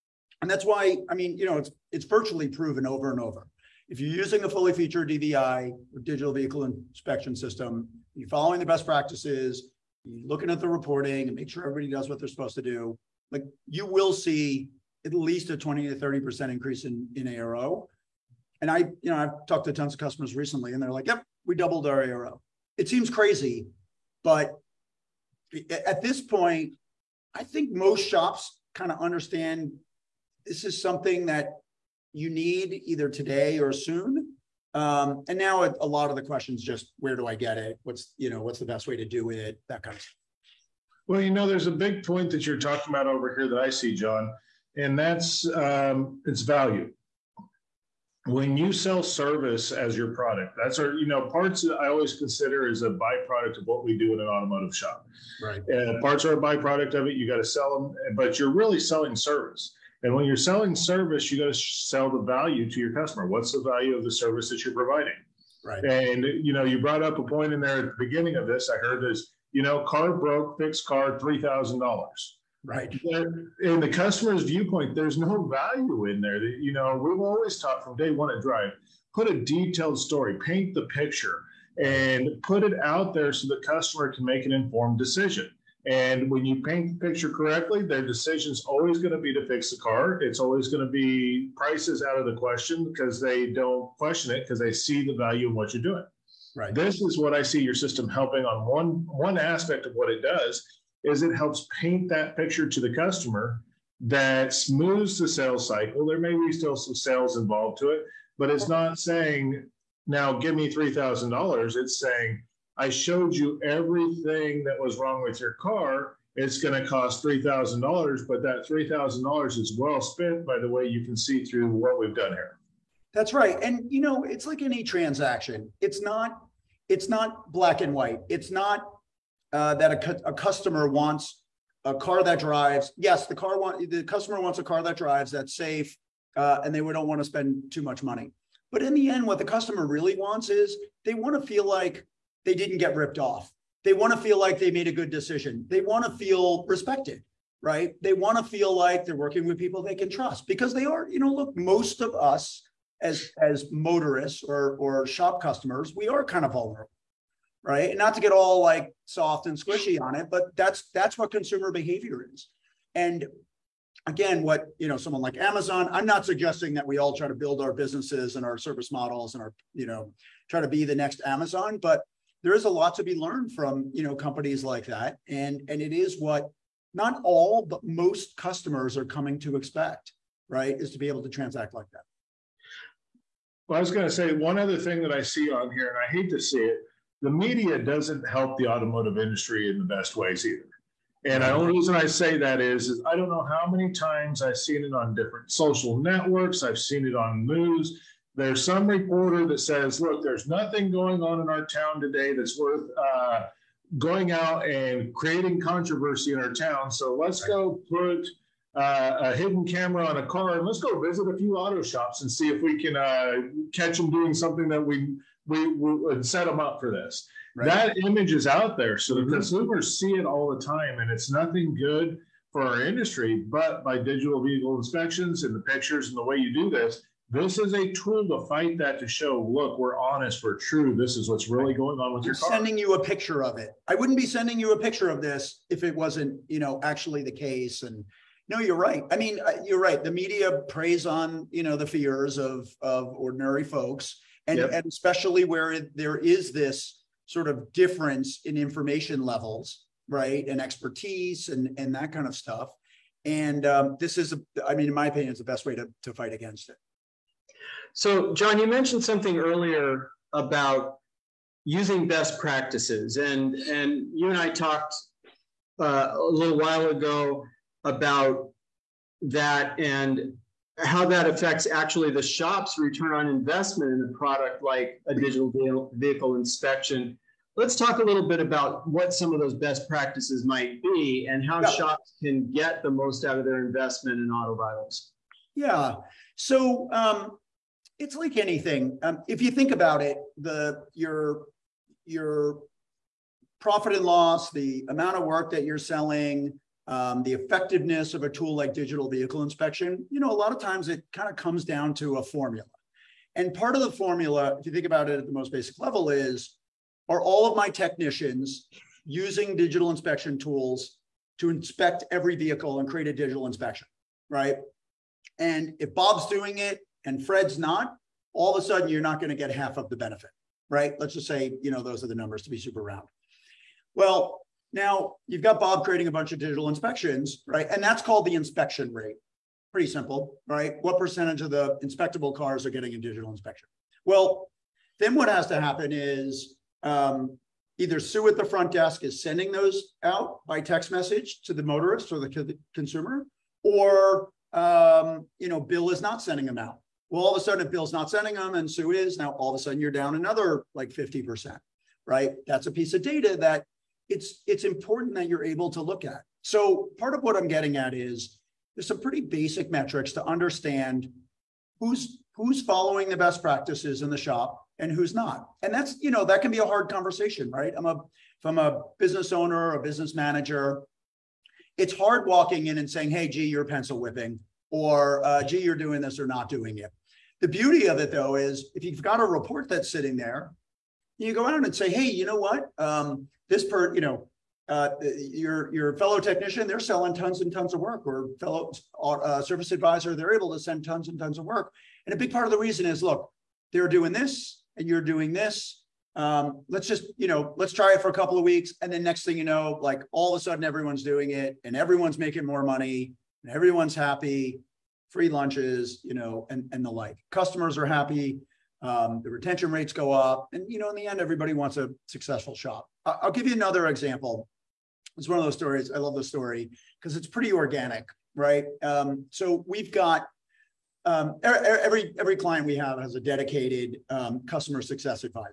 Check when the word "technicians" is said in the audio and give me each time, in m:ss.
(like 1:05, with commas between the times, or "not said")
5:07, 6:26.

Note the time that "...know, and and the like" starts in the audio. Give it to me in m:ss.
6:46.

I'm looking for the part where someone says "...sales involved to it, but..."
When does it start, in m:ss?
1:46.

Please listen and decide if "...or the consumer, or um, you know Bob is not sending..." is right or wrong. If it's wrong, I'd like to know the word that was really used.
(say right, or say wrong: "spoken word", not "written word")
wrong: "Bill", not "Bob".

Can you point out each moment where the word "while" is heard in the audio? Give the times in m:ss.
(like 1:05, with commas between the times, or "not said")
4:26.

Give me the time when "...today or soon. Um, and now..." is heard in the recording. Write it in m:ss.
0:33.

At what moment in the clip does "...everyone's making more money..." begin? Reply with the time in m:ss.
6:41.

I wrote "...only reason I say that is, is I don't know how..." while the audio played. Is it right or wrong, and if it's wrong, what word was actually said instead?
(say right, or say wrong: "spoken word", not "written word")
right.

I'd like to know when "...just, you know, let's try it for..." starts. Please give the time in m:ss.
6:36.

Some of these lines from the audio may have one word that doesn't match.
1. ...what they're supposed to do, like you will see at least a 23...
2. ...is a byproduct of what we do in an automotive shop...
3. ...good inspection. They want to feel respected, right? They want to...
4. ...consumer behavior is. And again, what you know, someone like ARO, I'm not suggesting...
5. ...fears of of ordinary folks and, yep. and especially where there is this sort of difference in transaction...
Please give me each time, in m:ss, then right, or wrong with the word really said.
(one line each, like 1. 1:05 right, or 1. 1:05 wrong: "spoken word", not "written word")
1. 0:12 wrong: "20", not "23"
2. 0:52 right
3. 2:24 wrong: "decision", not "inspection"
4. 2:41 wrong: "Amazon", not "ARO"
5. 4:01 wrong: "information", not "transaction".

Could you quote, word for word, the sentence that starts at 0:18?
And I, you know, I've talked to tons of customers recently and they're like, yep, we doubled our ARO.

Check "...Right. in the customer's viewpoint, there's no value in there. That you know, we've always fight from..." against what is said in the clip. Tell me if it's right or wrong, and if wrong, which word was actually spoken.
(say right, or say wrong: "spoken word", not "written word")
wrong: "taught", not "fight".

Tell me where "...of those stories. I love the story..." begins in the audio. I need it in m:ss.
6:55.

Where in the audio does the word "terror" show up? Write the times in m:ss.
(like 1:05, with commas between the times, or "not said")
not said.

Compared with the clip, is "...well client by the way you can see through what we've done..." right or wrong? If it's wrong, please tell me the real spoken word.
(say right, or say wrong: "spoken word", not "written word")
wrong: "spent", not "client".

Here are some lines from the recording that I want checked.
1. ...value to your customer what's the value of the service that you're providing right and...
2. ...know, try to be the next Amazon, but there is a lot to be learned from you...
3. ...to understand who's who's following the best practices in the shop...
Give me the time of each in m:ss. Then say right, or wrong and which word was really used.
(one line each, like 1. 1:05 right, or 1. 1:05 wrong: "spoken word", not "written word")
1. 1:02 right
2. 2:49 right
3. 6:00 right.